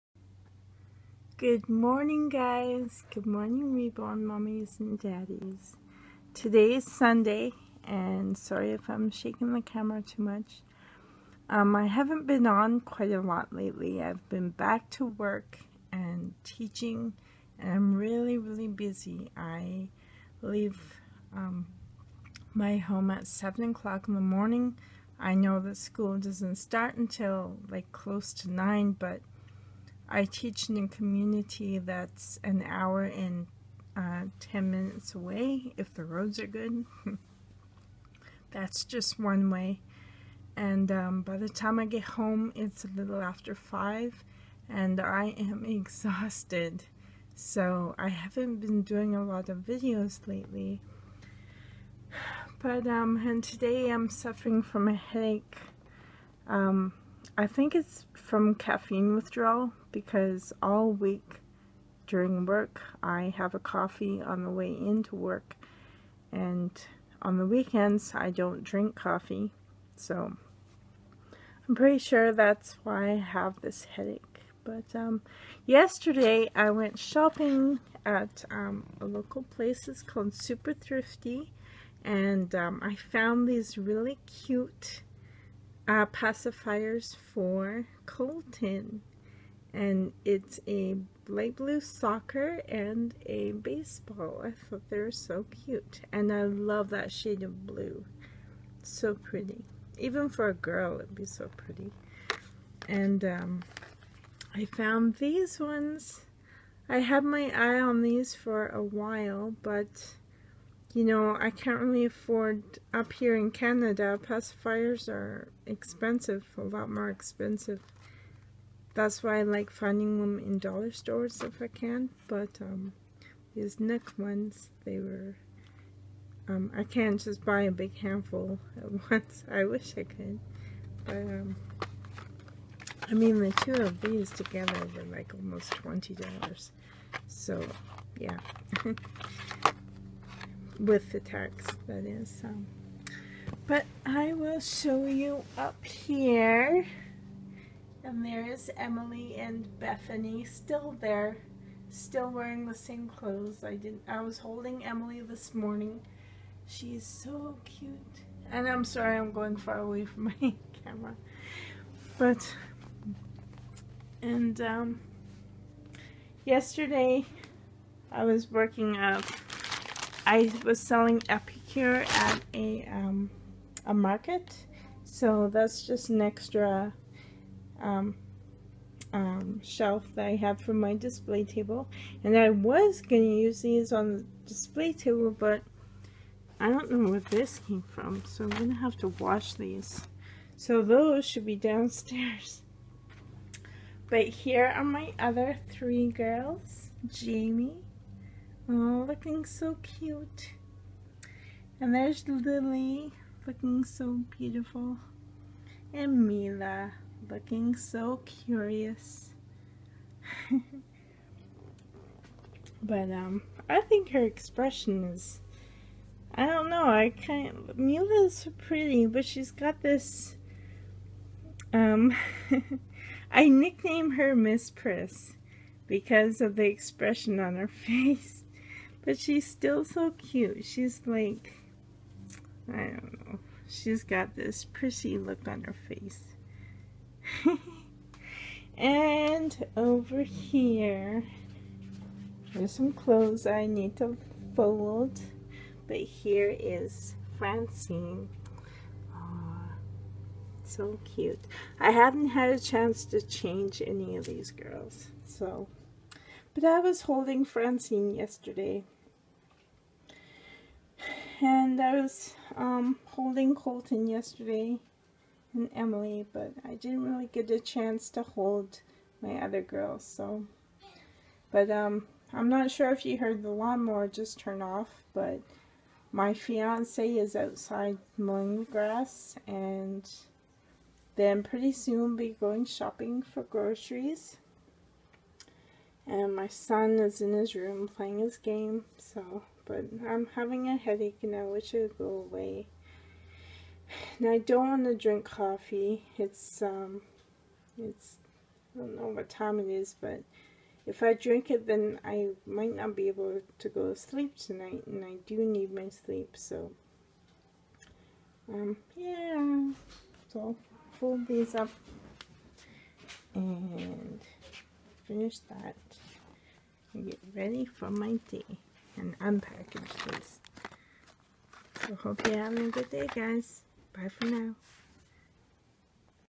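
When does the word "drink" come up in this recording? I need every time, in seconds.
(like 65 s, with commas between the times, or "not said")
68 s, 294 s, 301 s.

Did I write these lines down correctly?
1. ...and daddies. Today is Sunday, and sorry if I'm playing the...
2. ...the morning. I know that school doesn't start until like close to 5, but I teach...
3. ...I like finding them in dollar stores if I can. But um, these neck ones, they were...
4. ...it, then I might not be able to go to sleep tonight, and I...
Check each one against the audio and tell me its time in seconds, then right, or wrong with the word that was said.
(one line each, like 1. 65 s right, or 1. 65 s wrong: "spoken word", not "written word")
1. 4 s wrong: "shaking", not "playing"
2. 24 s wrong: "9", not "5"
3. 119 s right
4. 301 s right.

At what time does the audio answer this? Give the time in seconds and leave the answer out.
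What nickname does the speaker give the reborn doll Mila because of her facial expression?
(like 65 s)
224 s.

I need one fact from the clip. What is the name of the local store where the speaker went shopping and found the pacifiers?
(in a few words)
Super Thrifty.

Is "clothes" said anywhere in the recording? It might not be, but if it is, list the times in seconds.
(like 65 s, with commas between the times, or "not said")
153 s, 242 s.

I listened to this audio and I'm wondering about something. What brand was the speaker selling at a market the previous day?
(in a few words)
Epicure.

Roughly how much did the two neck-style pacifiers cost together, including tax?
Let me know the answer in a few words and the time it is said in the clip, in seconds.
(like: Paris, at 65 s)
$20, at 135 s.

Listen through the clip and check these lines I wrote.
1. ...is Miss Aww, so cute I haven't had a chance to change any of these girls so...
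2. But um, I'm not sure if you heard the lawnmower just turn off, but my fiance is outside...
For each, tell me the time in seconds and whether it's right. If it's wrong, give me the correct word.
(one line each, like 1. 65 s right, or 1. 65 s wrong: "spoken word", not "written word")
1. 246 s wrong: "Francine", not "Miss"
2. 271 s right.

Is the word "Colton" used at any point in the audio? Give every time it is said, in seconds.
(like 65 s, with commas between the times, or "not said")
88 s, 263 s.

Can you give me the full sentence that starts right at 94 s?
I thought they were so cute.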